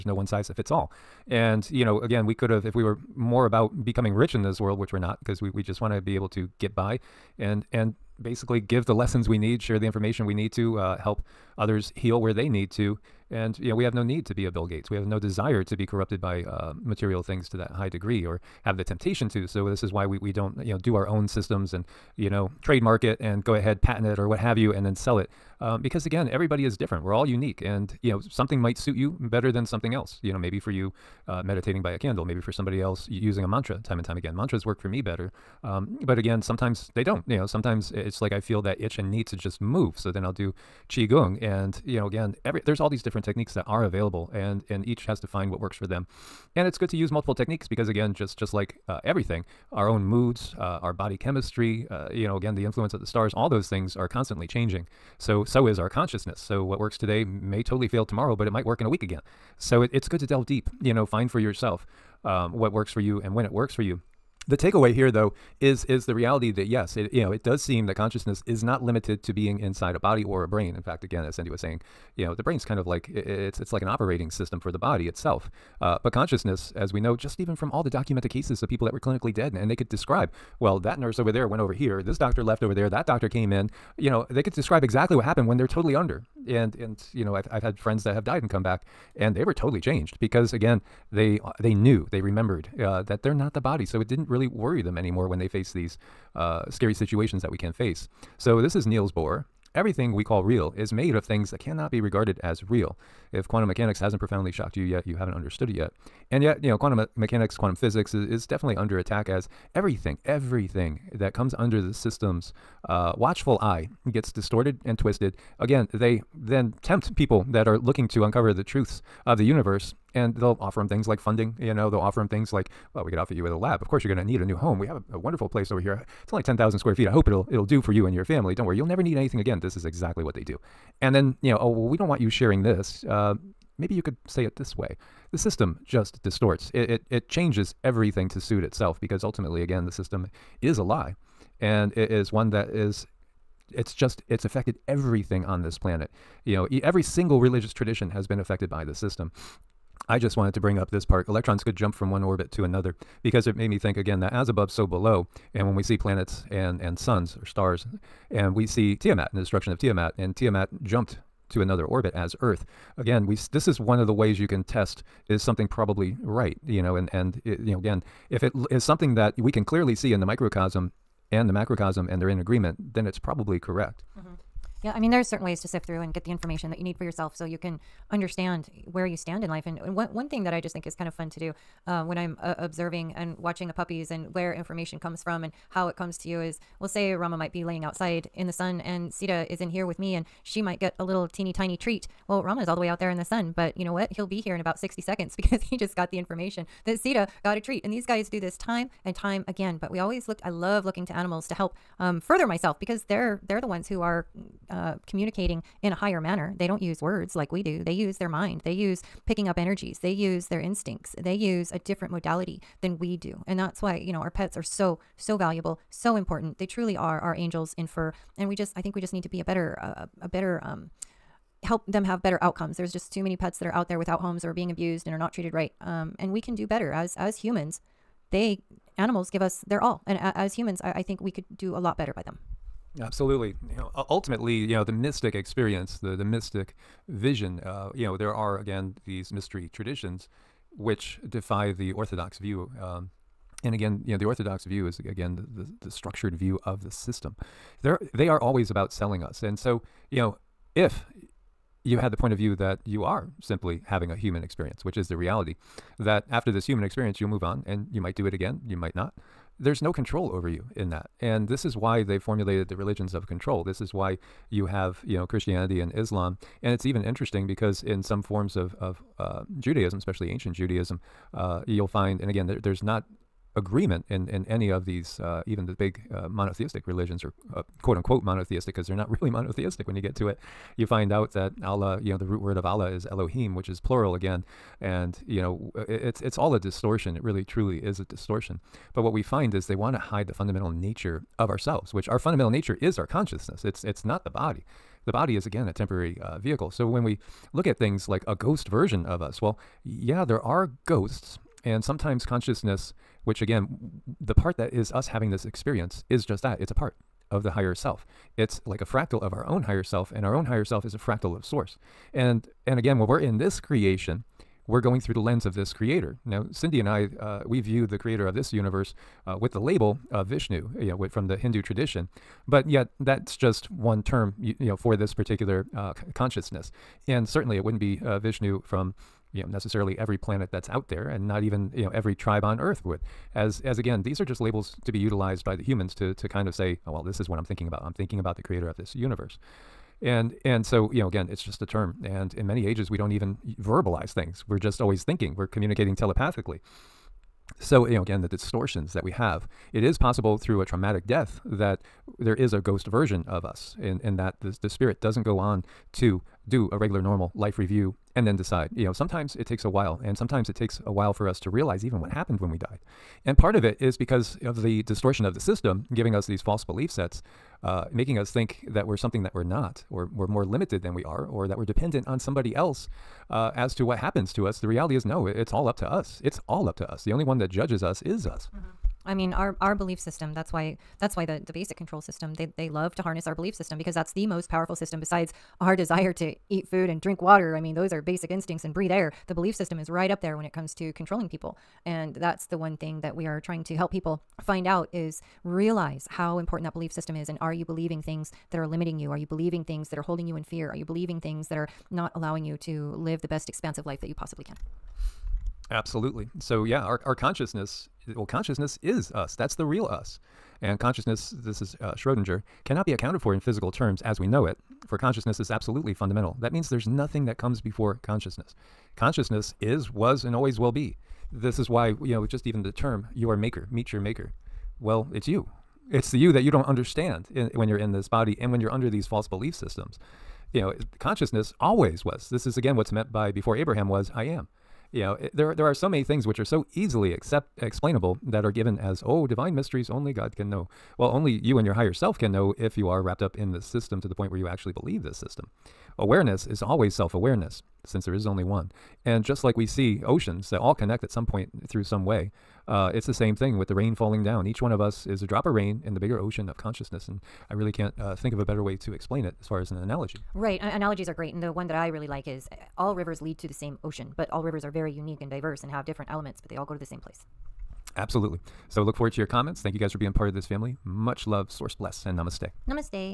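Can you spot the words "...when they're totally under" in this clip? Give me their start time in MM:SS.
01:25.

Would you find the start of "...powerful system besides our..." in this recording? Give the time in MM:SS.
06:24.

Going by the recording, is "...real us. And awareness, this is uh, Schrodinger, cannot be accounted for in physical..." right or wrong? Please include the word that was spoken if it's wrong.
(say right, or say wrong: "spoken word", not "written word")
wrong: "consciousness", not "awareness".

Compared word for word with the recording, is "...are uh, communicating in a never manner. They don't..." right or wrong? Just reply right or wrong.
wrong.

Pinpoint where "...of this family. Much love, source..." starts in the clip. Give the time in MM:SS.
07:50.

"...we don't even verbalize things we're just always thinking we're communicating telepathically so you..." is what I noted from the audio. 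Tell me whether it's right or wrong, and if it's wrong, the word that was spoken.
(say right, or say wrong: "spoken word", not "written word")
right.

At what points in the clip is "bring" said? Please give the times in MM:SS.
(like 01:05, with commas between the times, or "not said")
02:30.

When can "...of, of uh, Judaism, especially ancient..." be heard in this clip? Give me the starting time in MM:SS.
04:28.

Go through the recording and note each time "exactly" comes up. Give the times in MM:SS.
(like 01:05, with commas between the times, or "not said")
01:24, 02:09.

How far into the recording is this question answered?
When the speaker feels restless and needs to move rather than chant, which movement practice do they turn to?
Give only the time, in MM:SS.
00:40.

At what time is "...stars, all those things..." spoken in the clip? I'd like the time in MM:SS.
00:53.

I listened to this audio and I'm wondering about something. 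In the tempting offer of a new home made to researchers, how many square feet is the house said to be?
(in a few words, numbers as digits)
10,000.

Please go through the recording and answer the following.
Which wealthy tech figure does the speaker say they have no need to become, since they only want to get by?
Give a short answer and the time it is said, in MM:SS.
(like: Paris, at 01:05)
Bill Gates, at 00:14.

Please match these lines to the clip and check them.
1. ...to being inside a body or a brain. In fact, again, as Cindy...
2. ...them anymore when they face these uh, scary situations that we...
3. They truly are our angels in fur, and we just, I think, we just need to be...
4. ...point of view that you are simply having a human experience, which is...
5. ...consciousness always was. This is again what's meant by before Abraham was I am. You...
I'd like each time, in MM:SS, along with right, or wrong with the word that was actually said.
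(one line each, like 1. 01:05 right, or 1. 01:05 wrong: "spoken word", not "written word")
1. 01:09 right
2. 01:34 right
3. 03:36 right
4. 04:12 right
5. 07:10 right.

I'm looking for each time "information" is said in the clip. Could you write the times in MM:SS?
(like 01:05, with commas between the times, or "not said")
00:09, 02:56, 03:04, 03:16.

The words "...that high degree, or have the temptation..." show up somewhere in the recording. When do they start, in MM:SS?
00:17.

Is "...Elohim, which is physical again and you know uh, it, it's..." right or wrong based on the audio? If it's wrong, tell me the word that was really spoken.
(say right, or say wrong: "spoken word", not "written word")
wrong: "plural", not "physical".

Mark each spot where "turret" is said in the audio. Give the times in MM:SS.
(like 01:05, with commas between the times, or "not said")
not said.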